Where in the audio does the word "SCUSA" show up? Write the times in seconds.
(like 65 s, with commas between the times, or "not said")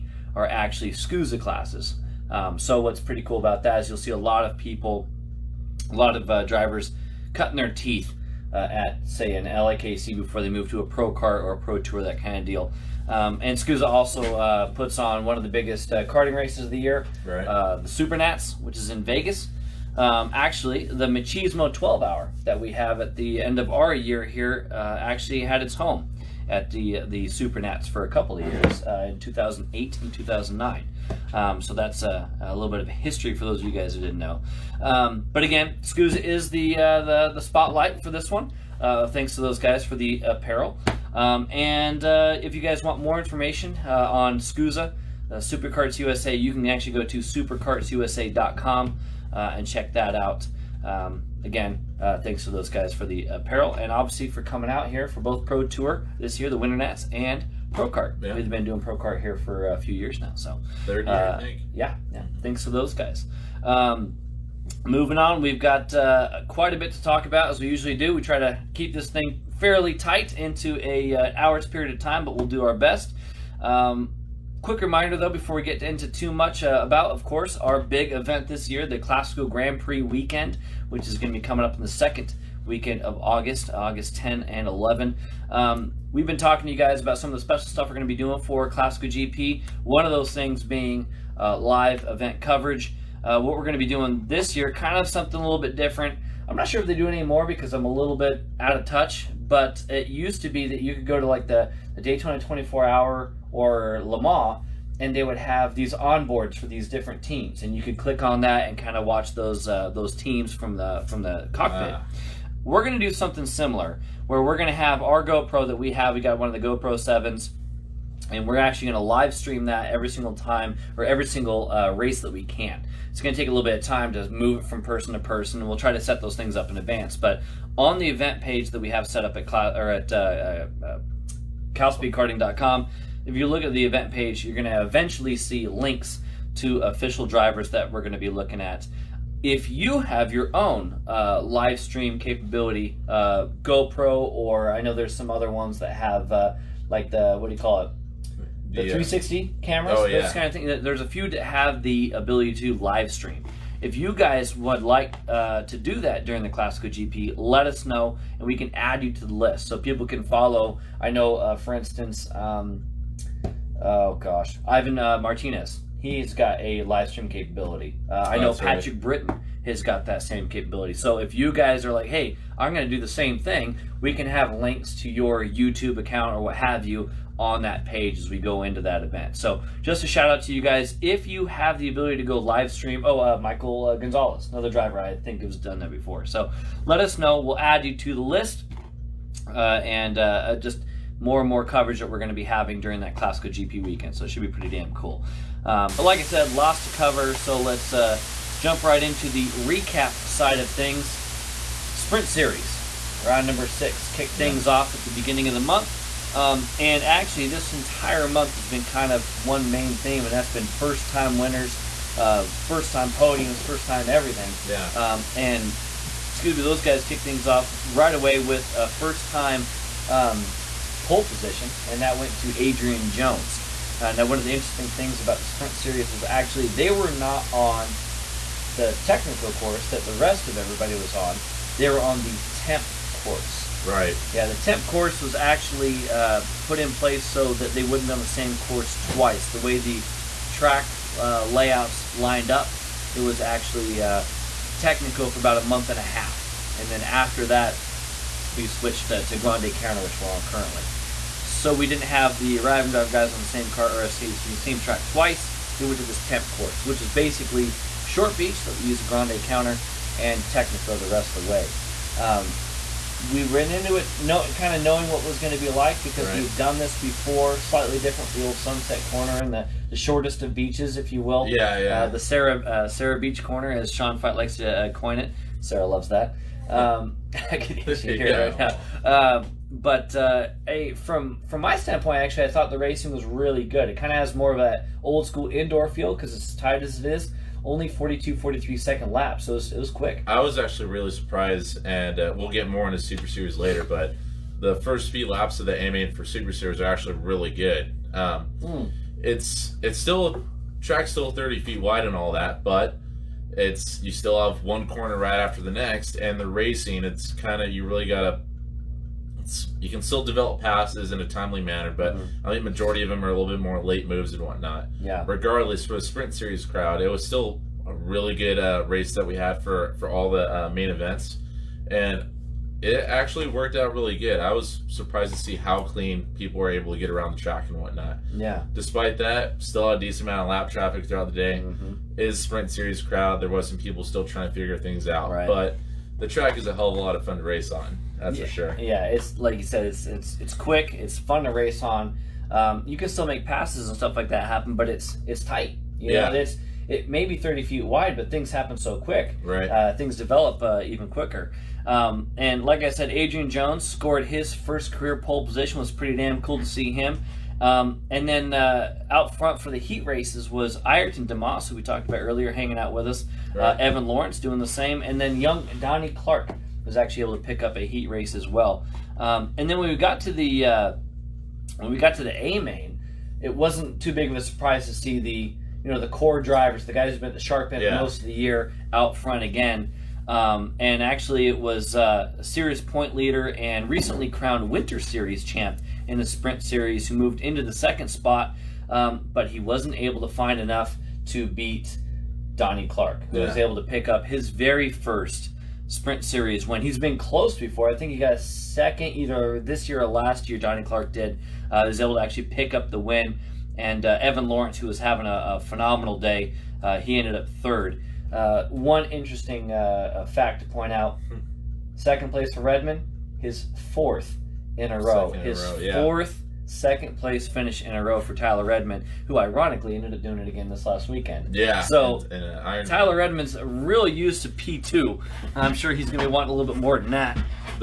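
0 s, 13 s, 35 s, 44 s.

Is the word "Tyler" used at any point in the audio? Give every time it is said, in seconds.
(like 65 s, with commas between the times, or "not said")
418 s, 422 s.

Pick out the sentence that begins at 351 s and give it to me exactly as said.
Um, and like I said, Adrian Jones scored his first career pole position.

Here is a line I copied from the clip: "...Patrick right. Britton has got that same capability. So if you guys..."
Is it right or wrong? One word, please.
right.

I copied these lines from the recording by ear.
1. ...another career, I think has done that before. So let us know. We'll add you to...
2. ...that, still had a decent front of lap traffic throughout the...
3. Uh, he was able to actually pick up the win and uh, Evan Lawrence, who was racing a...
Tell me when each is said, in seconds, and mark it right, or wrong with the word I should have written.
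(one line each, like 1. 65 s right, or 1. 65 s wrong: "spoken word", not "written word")
1. 184 s wrong: "driver", not "career"
2. 329 s wrong: "amount", not "front"
3. 401 s wrong: "having", not "racing".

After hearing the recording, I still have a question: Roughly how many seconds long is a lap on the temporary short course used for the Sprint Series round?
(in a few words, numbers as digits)
42-43 seconds.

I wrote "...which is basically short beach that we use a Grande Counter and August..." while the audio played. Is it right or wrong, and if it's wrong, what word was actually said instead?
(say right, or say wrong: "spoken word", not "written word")
wrong: "Technico", not "August".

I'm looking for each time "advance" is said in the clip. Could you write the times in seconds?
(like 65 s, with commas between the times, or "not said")
126 s.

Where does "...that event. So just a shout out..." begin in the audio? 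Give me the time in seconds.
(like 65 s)
178 s.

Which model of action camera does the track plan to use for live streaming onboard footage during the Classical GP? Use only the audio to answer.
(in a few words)
GoPro 7.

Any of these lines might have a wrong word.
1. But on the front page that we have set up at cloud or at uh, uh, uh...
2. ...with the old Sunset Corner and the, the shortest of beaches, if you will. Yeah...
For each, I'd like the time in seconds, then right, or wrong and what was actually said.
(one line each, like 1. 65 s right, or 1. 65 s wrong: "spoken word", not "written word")
1. 127 s wrong: "event", not "front"
2. 268 s right.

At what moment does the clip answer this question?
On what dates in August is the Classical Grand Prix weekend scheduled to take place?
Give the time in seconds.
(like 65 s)
83 s.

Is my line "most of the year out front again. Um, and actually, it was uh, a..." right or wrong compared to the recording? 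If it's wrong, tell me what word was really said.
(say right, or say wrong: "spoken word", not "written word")
right.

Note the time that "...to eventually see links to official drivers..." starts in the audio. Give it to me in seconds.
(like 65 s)
134 s.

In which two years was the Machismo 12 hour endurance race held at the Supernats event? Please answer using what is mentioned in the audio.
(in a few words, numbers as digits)
2008 and 2009.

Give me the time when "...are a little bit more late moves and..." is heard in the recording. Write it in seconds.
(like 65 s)
313 s.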